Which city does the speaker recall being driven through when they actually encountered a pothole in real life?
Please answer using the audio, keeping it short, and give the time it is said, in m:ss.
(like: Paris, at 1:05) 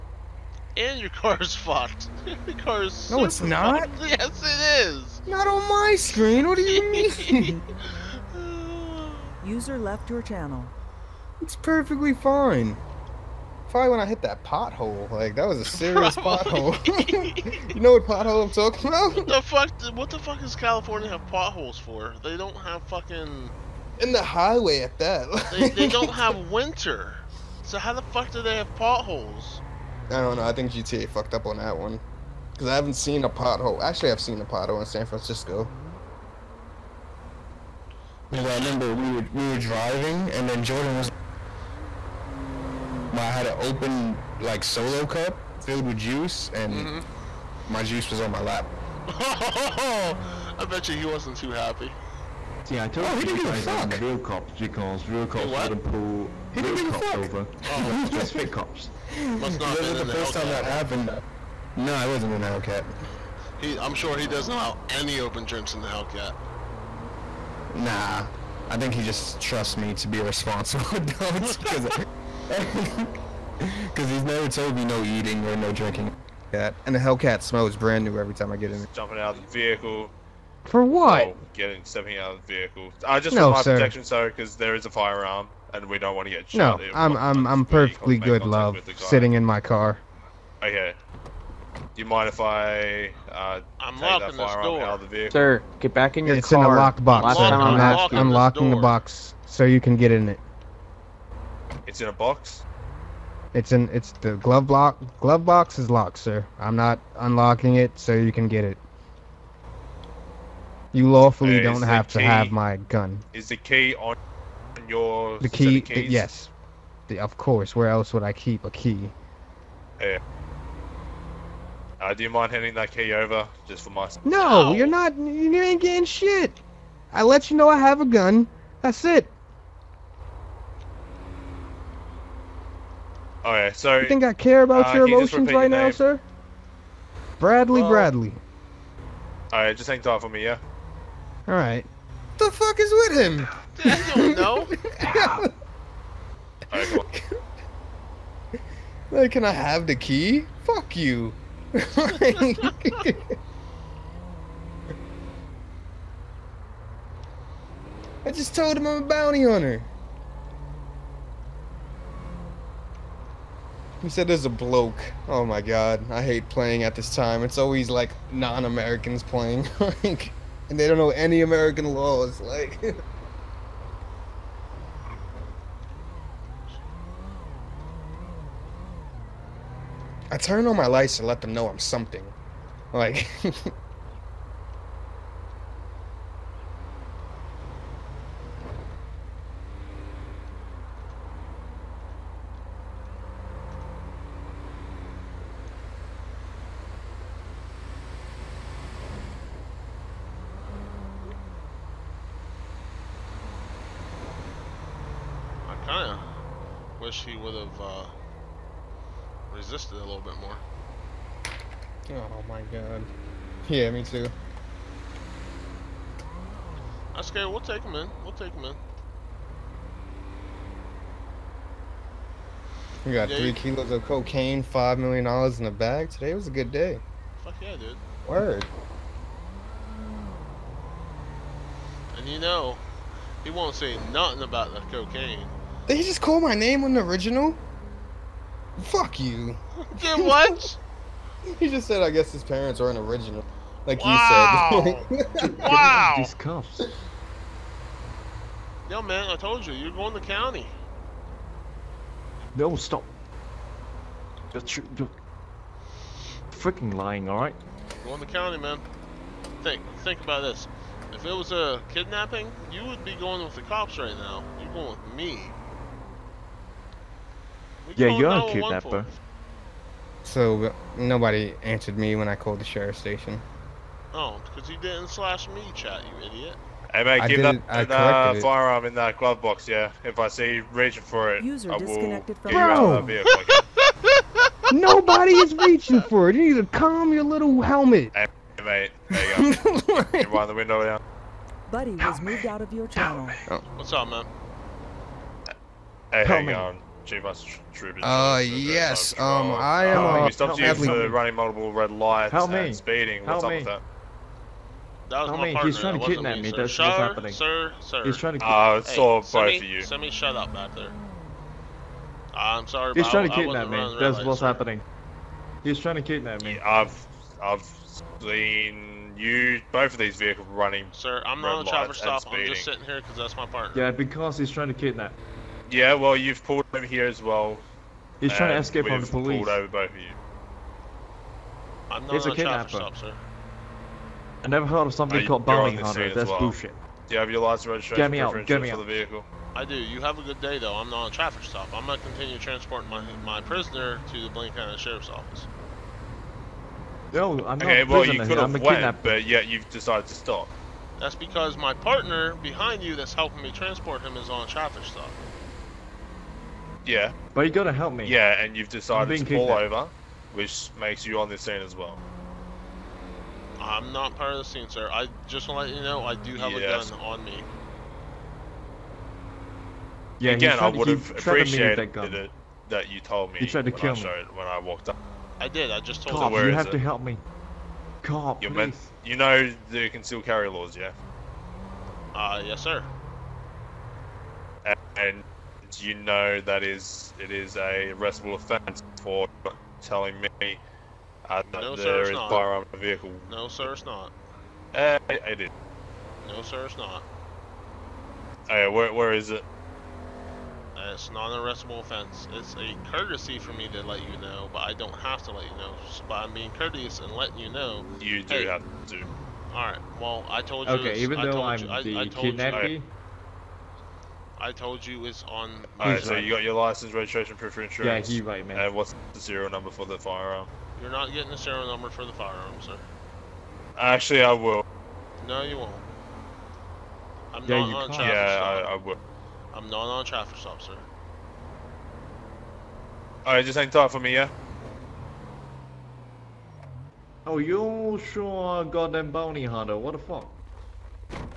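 San Francisco, at 0:34.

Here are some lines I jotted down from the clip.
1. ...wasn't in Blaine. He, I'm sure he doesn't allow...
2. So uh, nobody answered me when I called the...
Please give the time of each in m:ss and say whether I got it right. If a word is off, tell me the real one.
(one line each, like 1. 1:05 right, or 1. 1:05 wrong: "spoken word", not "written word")
1. 1:02 wrong: "Hellcat", not "Blaine"
2. 4:30 right.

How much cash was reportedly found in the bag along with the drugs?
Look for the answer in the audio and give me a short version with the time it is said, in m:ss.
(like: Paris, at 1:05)
5 million dollars, at 3:44.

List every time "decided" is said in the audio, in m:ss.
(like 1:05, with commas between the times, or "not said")
5:49, 5:58.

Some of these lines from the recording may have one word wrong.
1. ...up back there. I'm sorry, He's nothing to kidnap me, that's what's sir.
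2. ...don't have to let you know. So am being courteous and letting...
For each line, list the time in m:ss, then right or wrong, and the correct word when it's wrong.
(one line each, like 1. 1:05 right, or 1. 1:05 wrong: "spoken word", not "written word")
1. 5:10 wrong: "trying", not "nothing"
2. 6:44 right.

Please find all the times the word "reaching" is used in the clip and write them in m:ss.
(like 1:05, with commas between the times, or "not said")
4:40, 4:45.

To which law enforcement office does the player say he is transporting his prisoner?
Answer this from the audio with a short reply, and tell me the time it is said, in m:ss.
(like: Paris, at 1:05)
Blaine County Sheriff's Office, at 5:44.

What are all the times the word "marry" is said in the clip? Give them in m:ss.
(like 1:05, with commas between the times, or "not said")
not said.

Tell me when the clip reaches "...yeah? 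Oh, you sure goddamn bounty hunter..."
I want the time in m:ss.
7:14.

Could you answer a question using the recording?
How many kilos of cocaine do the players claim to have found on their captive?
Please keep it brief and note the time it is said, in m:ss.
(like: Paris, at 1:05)
3, at 3:43.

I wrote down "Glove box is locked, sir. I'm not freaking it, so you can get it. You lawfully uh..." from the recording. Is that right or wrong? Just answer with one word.
wrong.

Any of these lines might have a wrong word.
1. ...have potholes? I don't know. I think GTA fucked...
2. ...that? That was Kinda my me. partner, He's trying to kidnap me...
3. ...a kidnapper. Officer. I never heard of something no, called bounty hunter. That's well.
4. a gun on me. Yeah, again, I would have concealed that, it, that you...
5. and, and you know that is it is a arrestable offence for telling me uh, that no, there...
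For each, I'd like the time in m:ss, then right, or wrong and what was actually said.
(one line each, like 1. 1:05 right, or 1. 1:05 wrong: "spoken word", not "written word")
1. 0:28 right
2. 5:03 wrong: "Help", not "Kinda"
3. 5:32 right
4. 6:06 wrong: "appreciated", not "concealed"
5. 6:24 right.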